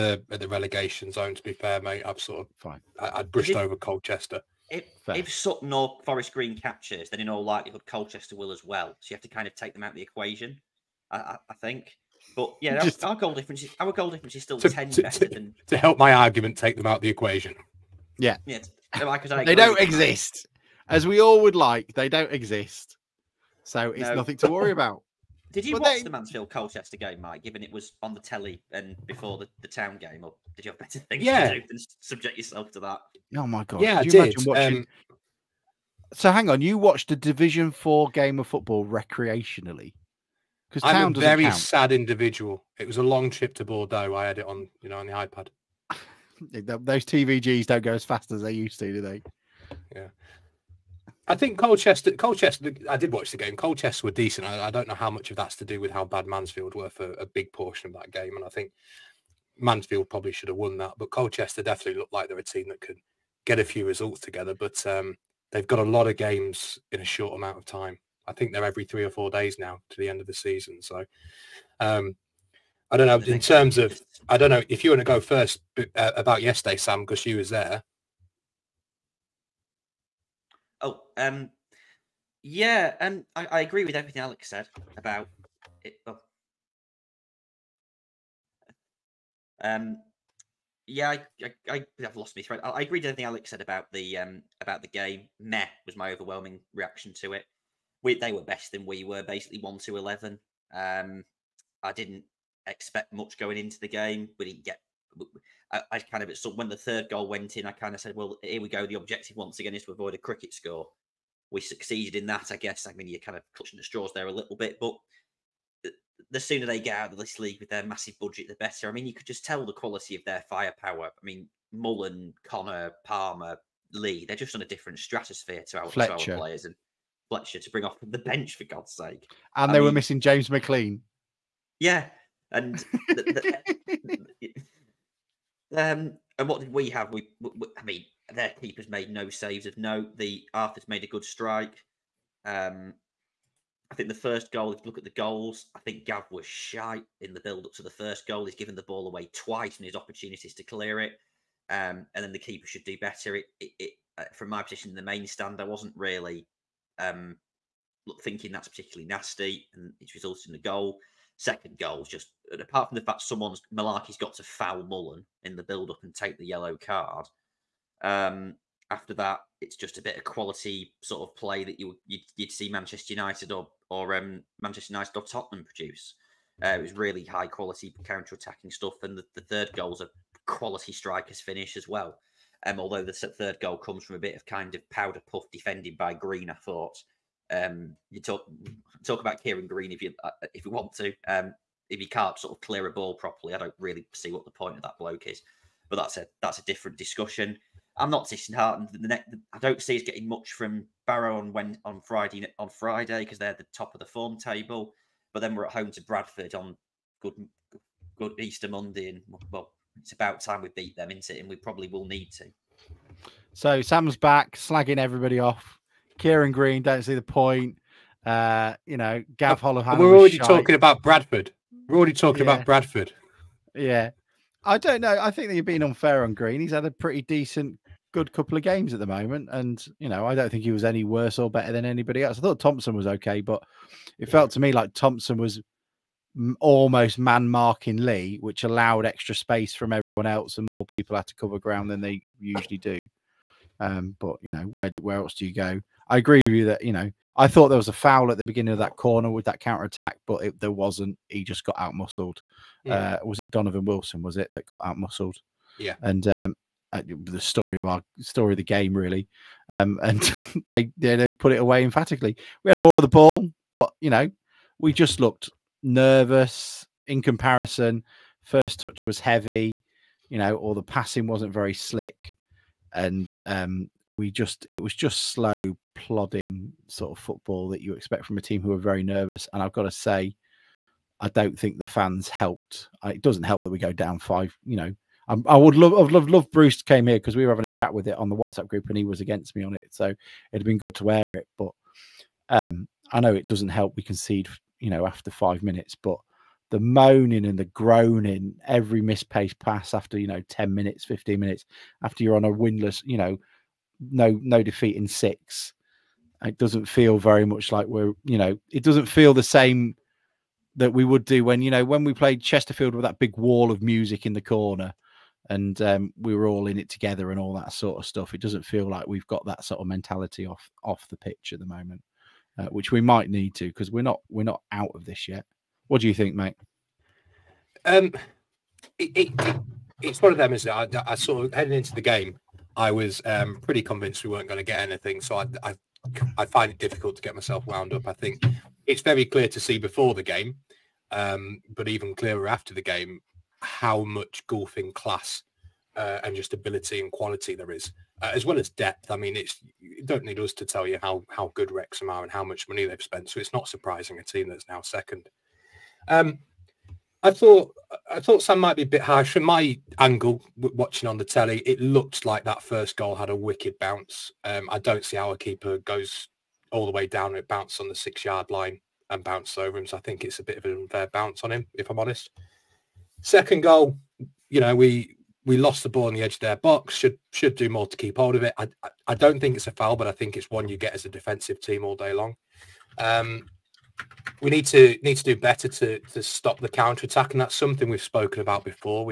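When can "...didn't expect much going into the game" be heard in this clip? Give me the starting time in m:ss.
1:41.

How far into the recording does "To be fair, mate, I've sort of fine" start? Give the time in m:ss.
0:01.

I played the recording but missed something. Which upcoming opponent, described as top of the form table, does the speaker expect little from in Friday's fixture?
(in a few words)
Barrow.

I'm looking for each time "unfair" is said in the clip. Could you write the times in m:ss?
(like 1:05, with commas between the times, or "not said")
3:45, 6:10.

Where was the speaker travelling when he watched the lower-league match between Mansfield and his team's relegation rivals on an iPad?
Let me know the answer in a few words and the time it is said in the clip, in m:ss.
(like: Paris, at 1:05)
Bordeaux, at 0:43.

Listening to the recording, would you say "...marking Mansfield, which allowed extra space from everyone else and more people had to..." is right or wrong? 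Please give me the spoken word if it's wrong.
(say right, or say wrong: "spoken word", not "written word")
wrong: "Lee", not "Mansfield".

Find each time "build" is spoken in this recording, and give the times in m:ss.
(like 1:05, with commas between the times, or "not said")
2:27, 2:45.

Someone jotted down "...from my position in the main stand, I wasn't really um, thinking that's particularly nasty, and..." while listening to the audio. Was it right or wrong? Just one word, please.
right.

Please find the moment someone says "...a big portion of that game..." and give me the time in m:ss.
0:57.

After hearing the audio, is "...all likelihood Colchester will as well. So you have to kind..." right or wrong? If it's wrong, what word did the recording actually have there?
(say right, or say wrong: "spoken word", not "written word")
right.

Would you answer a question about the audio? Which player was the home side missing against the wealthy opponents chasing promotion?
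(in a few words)
James McLean.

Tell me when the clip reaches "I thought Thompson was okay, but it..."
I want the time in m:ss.
3:52.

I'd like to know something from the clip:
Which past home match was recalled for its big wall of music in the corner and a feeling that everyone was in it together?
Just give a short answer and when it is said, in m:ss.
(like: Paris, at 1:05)
Chesterfield, at 5:12.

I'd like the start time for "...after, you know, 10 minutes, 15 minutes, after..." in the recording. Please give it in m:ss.
4:59.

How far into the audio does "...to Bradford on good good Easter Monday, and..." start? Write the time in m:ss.
3:25.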